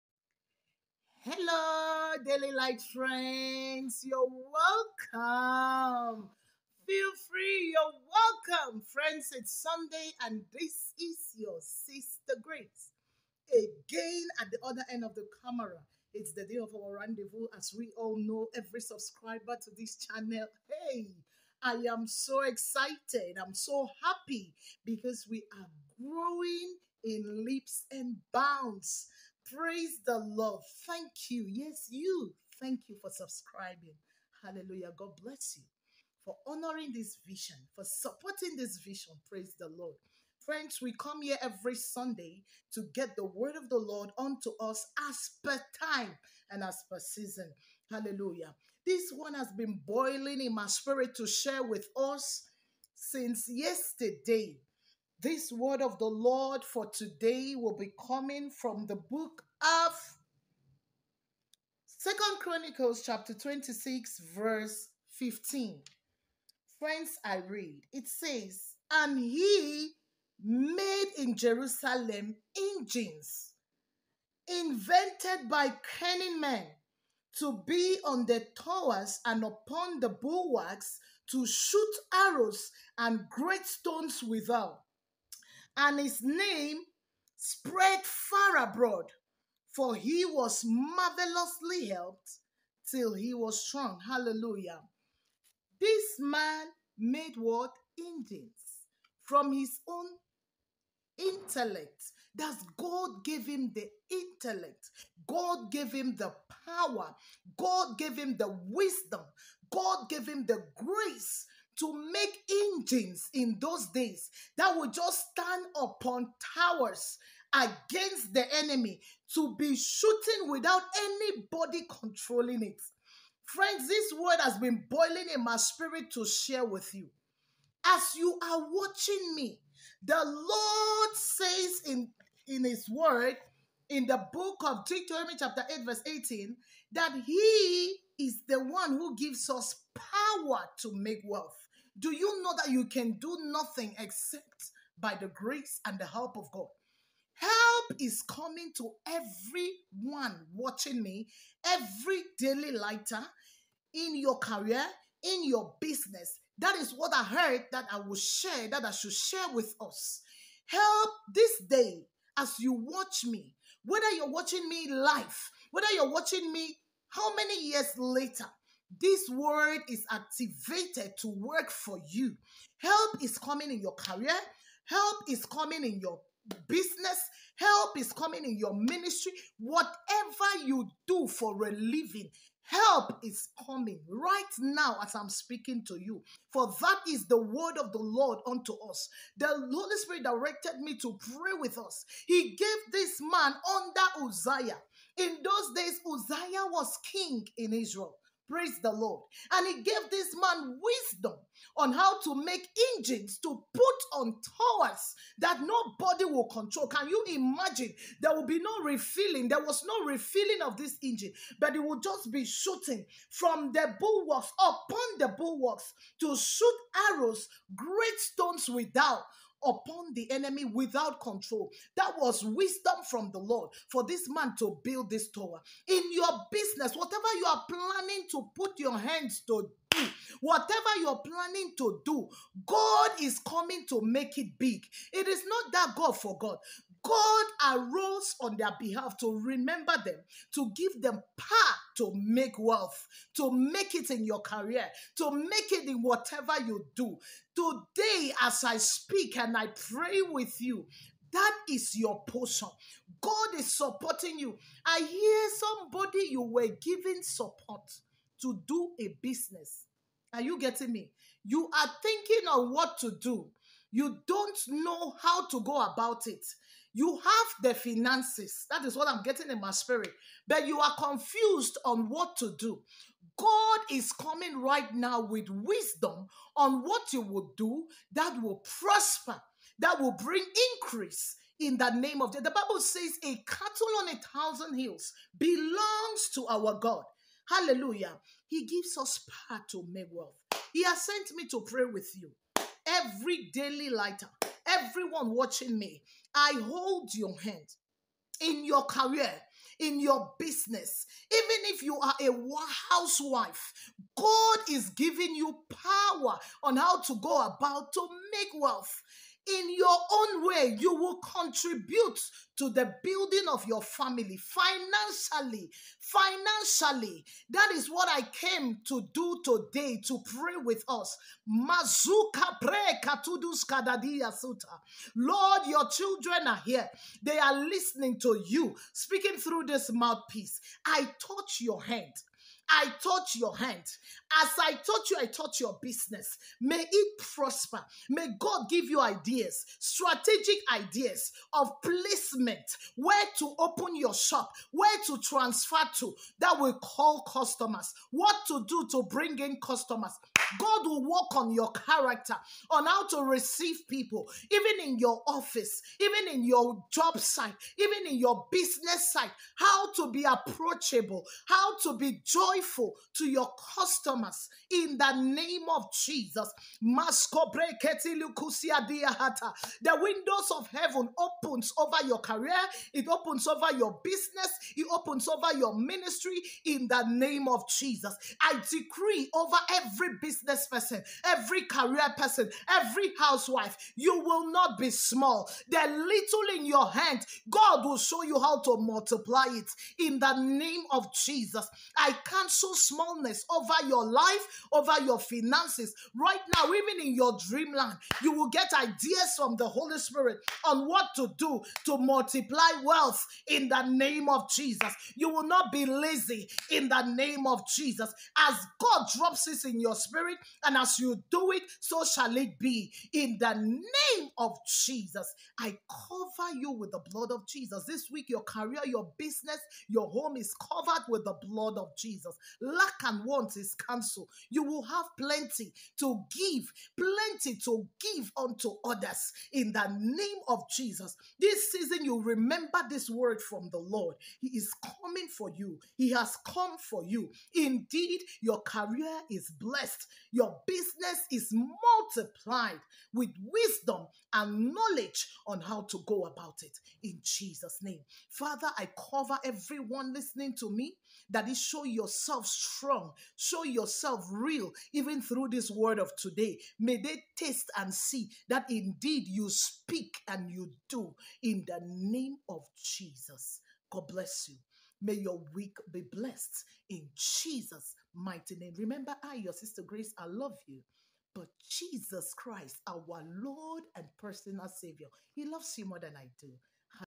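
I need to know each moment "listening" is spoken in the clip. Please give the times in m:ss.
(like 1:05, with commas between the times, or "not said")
5:27, 7:30.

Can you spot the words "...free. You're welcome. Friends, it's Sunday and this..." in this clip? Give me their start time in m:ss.
0:07.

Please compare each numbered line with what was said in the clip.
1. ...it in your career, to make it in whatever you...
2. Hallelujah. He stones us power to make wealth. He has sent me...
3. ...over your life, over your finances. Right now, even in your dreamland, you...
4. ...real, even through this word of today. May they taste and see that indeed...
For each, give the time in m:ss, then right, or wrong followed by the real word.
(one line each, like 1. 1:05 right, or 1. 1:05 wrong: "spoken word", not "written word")
1. 4:03 right
2. 4:47 wrong: "gives", not "stones"
3. 6:33 right
4. 7:34 right.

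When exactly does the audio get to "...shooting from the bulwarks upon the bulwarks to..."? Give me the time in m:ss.
3:32.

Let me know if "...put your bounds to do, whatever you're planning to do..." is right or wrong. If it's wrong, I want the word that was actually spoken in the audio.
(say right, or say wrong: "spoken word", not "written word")
wrong: "hands", not "bounds".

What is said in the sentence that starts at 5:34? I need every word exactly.
As I touch you, I touch your business.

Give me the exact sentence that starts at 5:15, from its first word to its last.
Financially, that is what I came to do today to pray with us.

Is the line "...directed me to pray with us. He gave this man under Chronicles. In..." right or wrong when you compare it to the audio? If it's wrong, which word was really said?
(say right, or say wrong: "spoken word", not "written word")
wrong: "Uzziah", not "Chronicles".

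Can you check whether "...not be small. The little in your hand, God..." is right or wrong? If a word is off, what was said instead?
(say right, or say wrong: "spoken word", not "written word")
right.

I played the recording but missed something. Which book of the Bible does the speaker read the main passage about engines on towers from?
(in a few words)
Second Chronicles.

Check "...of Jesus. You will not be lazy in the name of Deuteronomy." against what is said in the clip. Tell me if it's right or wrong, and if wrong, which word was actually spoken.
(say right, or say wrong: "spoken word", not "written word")
wrong: "Jesus", not "Deuteronomy".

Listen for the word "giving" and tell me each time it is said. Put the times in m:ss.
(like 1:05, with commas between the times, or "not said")
4:16, 5:04.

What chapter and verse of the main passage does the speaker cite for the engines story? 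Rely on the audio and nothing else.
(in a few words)
Chapter 26 verse 15.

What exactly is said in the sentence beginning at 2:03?
Friends, this word has been boiling in my spirit to share with you.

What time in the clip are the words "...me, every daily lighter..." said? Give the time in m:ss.
2:31.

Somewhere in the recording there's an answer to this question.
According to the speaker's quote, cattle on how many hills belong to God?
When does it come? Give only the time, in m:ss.
4:44.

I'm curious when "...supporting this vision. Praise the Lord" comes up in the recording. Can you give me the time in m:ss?
0:37.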